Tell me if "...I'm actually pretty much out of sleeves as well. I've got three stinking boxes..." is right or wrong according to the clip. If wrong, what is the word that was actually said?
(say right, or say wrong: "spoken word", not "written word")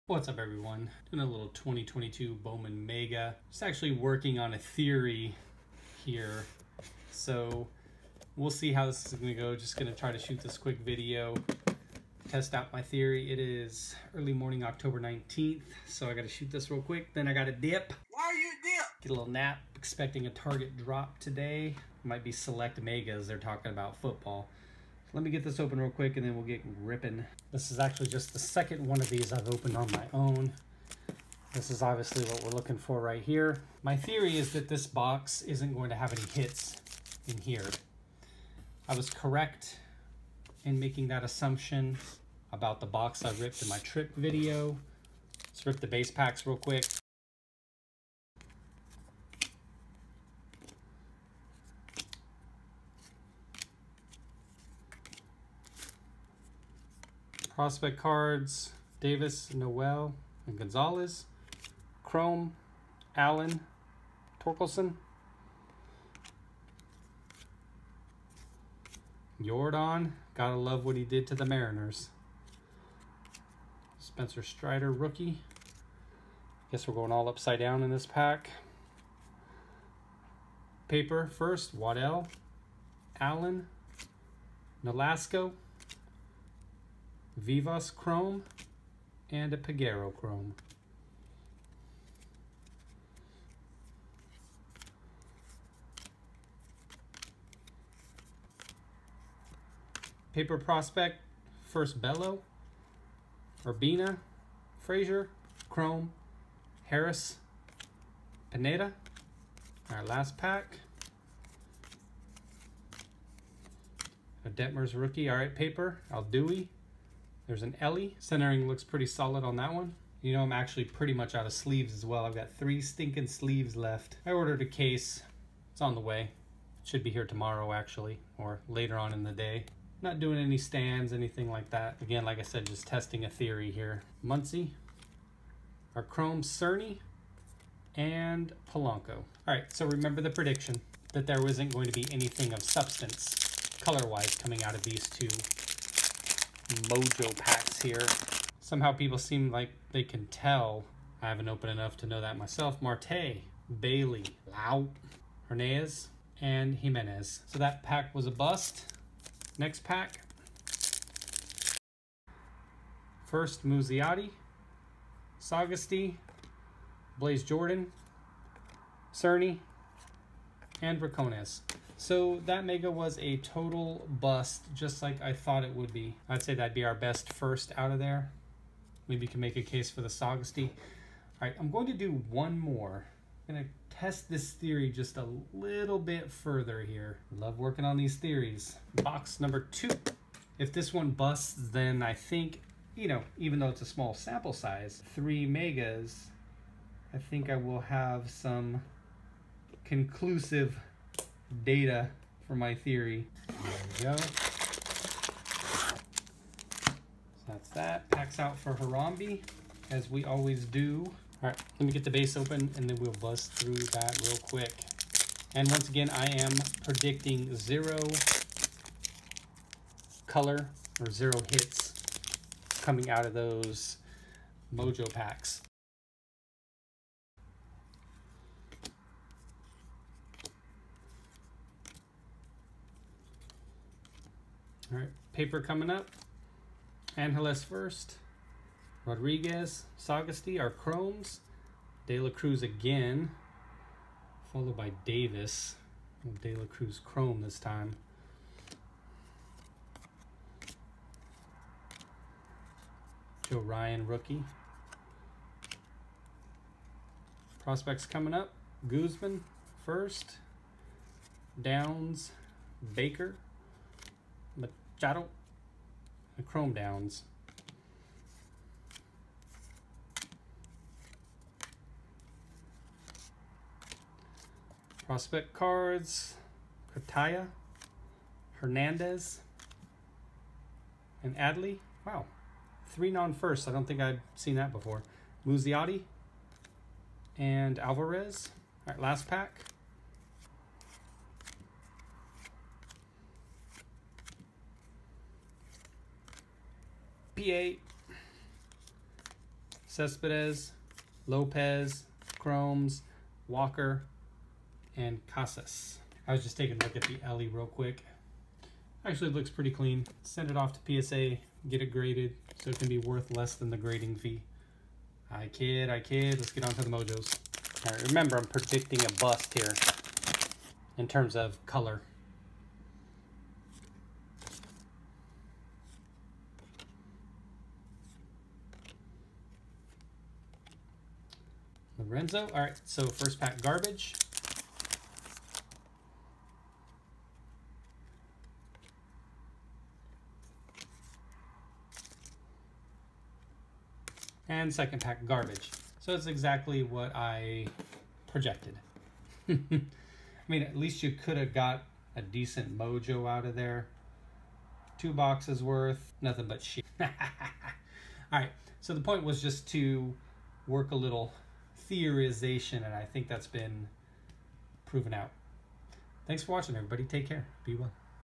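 wrong: "sleeves", not "boxes".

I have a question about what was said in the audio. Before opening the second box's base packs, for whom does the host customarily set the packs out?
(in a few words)
Harambe.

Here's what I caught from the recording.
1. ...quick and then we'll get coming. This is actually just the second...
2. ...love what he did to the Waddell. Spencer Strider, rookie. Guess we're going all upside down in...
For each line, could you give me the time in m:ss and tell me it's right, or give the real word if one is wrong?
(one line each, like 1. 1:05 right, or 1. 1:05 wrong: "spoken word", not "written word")
1. 0:25 wrong: "ripping", not "coming"
2. 1:10 wrong: "Mariners", not "Waddell".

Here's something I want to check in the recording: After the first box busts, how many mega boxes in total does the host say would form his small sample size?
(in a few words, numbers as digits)
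3.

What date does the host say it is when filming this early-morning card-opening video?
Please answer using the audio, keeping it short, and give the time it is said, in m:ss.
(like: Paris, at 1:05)
October 19th, at 0:14.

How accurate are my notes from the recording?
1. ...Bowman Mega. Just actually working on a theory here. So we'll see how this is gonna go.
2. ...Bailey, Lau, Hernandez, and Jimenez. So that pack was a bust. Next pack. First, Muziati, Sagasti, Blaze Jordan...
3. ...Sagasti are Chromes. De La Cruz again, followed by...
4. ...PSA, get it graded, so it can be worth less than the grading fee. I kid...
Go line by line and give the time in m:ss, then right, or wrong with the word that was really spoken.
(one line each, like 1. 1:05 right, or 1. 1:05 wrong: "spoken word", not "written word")
1. 0:02 right
2. 2:33 right
3. 3:59 right
4. 5:11 right.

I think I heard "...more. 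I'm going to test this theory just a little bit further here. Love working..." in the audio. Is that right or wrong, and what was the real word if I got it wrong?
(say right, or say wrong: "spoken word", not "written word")
right.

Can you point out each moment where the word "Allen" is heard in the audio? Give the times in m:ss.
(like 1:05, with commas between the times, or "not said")
1:03, 1:23.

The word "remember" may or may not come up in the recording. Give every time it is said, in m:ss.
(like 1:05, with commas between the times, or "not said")
2:19, 5:18.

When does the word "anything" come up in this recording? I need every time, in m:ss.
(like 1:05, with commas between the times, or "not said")
2:11, 2:22.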